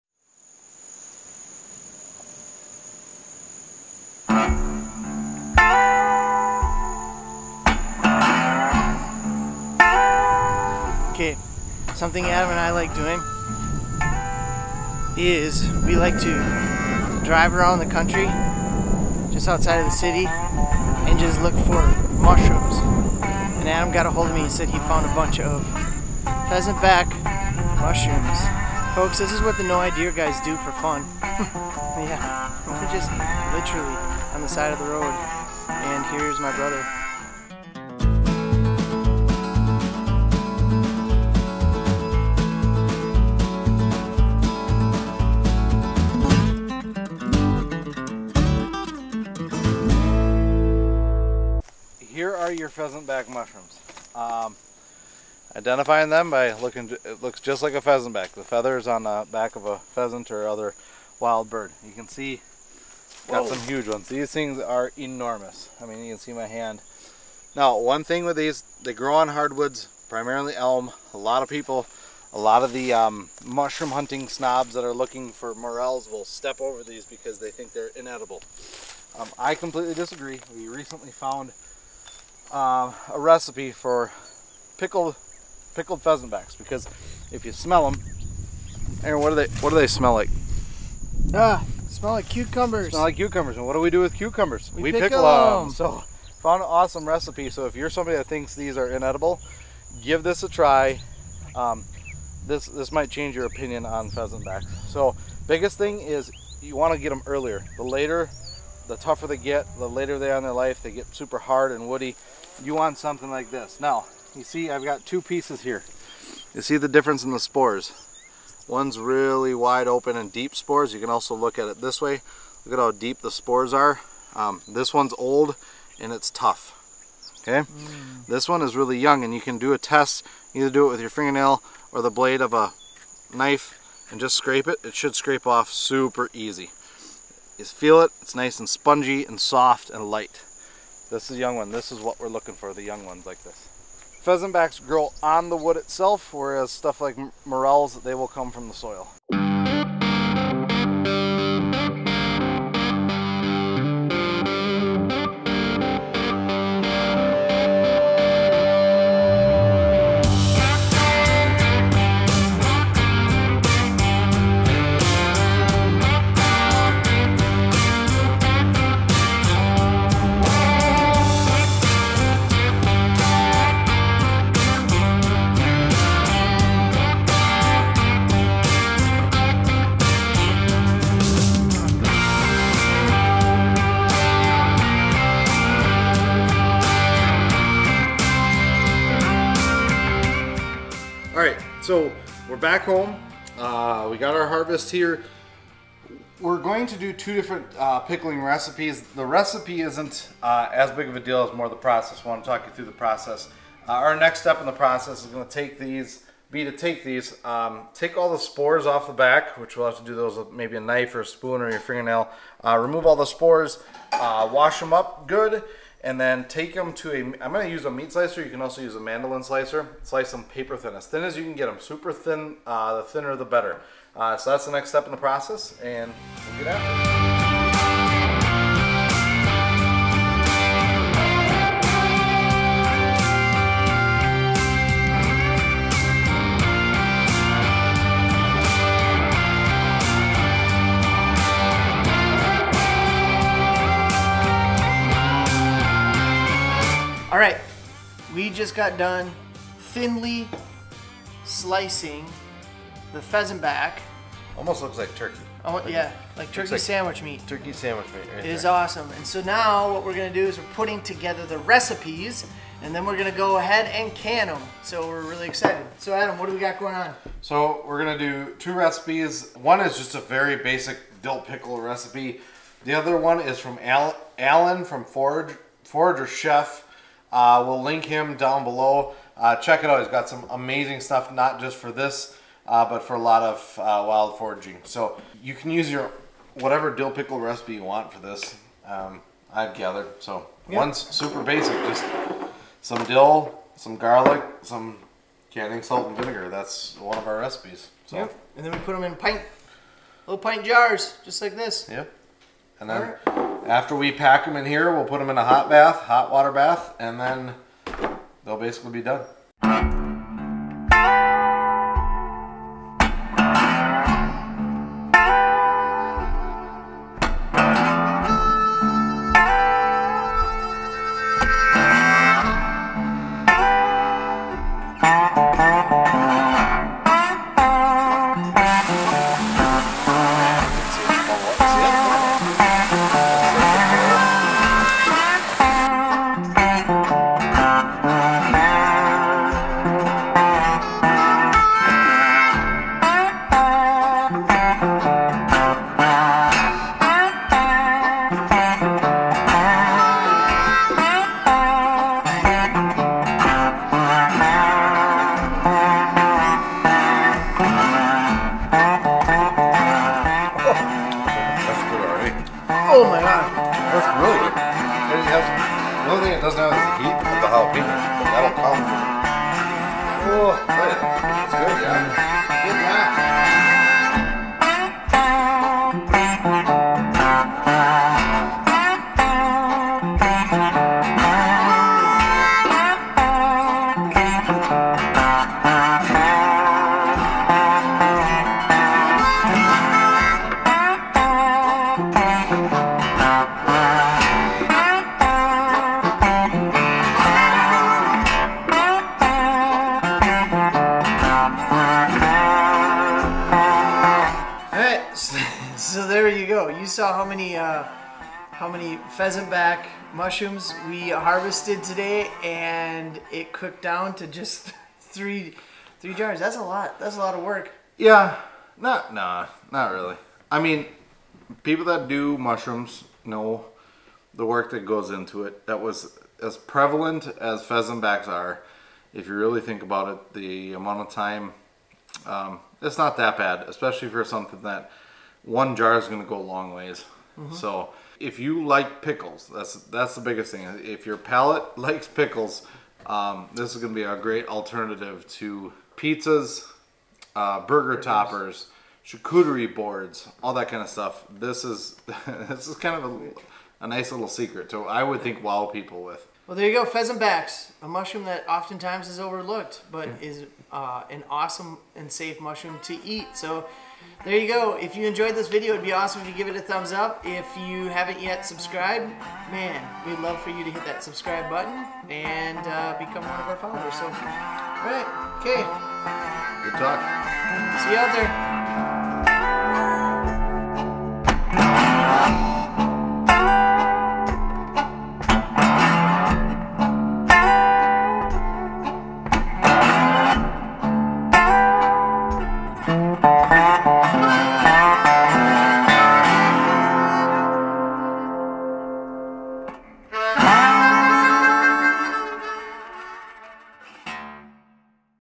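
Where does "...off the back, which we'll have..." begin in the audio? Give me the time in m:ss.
3:28.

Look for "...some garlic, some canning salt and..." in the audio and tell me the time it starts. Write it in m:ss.
4:53.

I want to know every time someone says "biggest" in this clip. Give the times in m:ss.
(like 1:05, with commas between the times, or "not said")
1:45, 7:20.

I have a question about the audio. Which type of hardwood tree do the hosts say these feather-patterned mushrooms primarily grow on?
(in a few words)
Elm.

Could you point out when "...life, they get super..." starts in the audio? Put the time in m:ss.
1:50.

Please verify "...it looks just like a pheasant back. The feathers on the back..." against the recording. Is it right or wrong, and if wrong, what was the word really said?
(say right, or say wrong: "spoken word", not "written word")
right.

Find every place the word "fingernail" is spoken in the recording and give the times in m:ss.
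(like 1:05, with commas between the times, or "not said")
2:11, 3:31.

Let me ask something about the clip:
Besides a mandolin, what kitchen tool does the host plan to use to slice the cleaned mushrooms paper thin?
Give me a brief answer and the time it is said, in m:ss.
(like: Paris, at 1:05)
Meat slicer, at 3:37.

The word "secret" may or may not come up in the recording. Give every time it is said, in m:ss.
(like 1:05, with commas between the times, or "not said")
7:34.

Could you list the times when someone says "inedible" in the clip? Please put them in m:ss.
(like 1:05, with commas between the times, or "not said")
1:17, 1:38.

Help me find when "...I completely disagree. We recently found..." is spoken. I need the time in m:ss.
1:19.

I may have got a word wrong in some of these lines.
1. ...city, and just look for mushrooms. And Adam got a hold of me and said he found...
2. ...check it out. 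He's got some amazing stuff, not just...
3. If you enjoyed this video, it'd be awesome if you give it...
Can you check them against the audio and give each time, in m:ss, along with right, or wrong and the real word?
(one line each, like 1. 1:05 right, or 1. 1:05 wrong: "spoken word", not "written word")
1. 0:19 right
2. 4:39 right
3. 7:44 right.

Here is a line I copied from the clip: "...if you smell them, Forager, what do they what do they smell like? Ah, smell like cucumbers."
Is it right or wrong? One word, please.
wrong.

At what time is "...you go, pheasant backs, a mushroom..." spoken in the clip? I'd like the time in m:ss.
7:36.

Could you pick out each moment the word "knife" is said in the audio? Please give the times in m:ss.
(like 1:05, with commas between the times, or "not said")
2:13, 3:30.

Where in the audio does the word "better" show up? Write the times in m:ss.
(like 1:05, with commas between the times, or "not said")
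3:43.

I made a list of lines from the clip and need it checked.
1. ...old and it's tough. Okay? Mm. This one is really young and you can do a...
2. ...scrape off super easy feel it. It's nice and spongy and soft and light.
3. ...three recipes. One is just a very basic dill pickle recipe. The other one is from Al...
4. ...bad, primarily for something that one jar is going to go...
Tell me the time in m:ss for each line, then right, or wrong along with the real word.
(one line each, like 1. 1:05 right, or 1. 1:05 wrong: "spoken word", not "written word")
1. 2:05 right
2. 2:15 right
3. 4:28 wrong: "two", not "three"
4. 7:13 wrong: "especially", not "primarily".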